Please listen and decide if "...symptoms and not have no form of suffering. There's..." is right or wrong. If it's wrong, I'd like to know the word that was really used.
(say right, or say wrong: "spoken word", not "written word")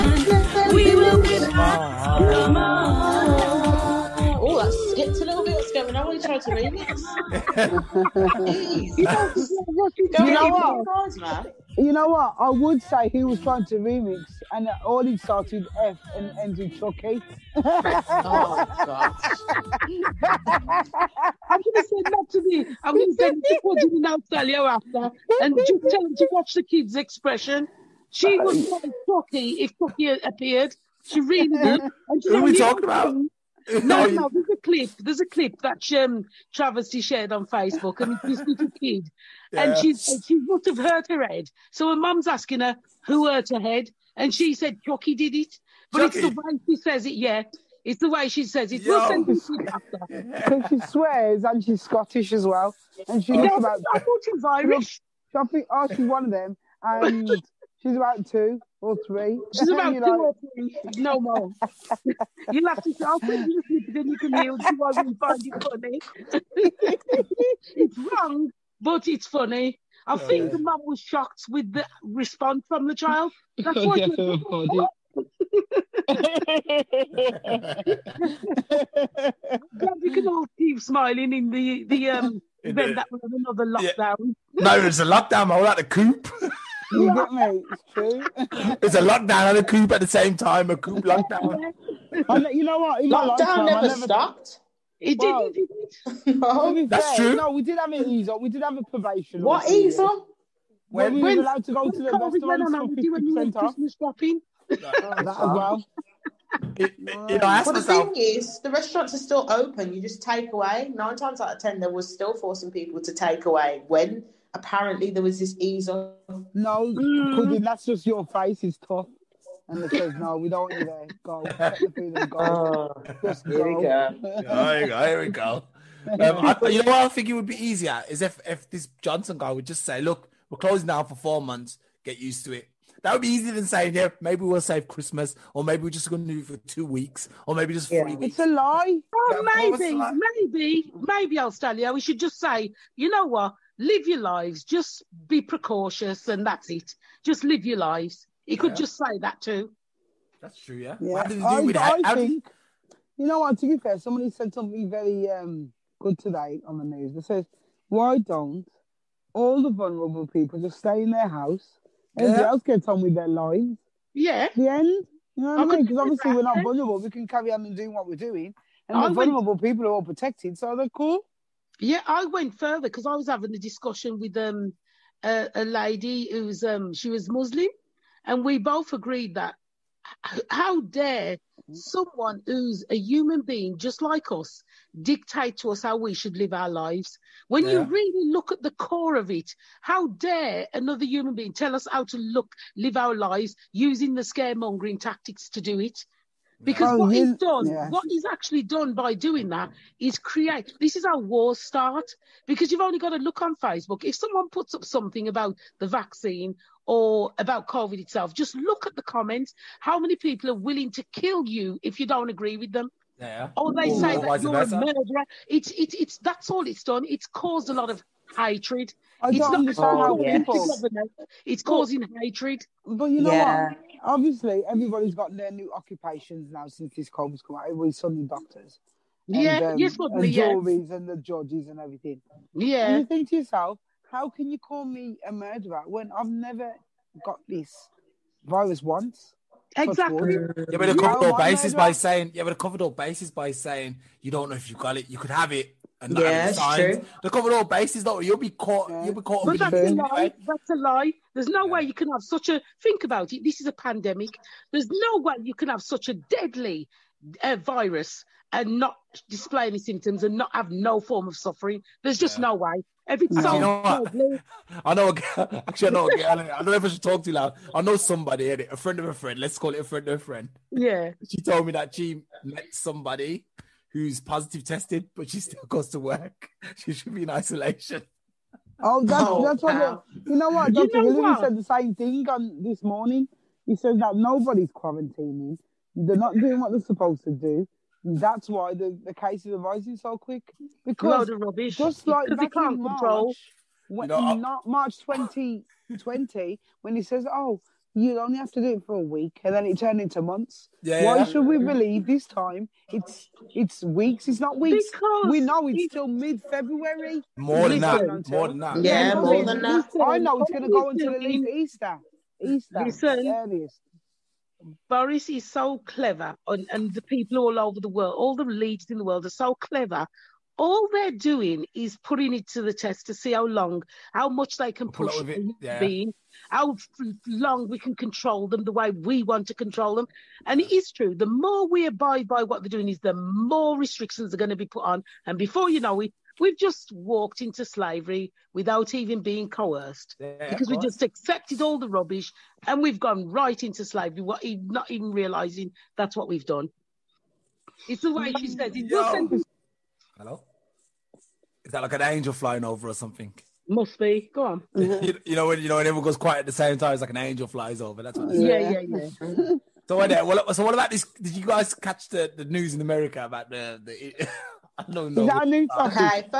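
right.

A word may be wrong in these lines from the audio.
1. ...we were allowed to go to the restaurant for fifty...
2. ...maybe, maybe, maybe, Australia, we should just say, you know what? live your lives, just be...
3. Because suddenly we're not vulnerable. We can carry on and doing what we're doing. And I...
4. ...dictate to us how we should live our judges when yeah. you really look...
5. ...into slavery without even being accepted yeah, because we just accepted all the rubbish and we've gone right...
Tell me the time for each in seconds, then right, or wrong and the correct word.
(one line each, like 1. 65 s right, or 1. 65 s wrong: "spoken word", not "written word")
1. 101 s right
2. 139 s right
3. 165 s wrong: "obviously", not "suddenly"
4. 185 s wrong: "lives", not "judges"
5. 337 s wrong: "coerced", not "accepted".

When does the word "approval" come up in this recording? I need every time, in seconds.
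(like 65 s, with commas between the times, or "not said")
not said.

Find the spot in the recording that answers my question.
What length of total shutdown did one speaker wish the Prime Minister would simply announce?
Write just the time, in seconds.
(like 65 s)
131 s.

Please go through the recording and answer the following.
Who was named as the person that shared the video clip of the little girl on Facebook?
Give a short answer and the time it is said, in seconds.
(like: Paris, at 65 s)
Travesty, at 36 s.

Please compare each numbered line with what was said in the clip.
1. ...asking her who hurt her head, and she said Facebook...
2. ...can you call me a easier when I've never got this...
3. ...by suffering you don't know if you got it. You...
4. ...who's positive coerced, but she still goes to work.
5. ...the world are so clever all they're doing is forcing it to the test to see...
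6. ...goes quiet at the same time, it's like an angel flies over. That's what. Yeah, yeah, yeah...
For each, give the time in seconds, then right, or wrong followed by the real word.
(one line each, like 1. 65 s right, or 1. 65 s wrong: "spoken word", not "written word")
1. 42 s wrong: "Chucky", not "Facebook"
2. 234 s wrong: "murderer", not "easier"
3. 243 s wrong: "saying", not "suffering"
4. 273 s wrong: "tested", not "coerced"
5. 318 s wrong: "putting", not "forcing"
6. 356 s right.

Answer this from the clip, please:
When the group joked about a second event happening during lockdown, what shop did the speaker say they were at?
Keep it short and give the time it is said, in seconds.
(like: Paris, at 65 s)
the coop, at 85 s.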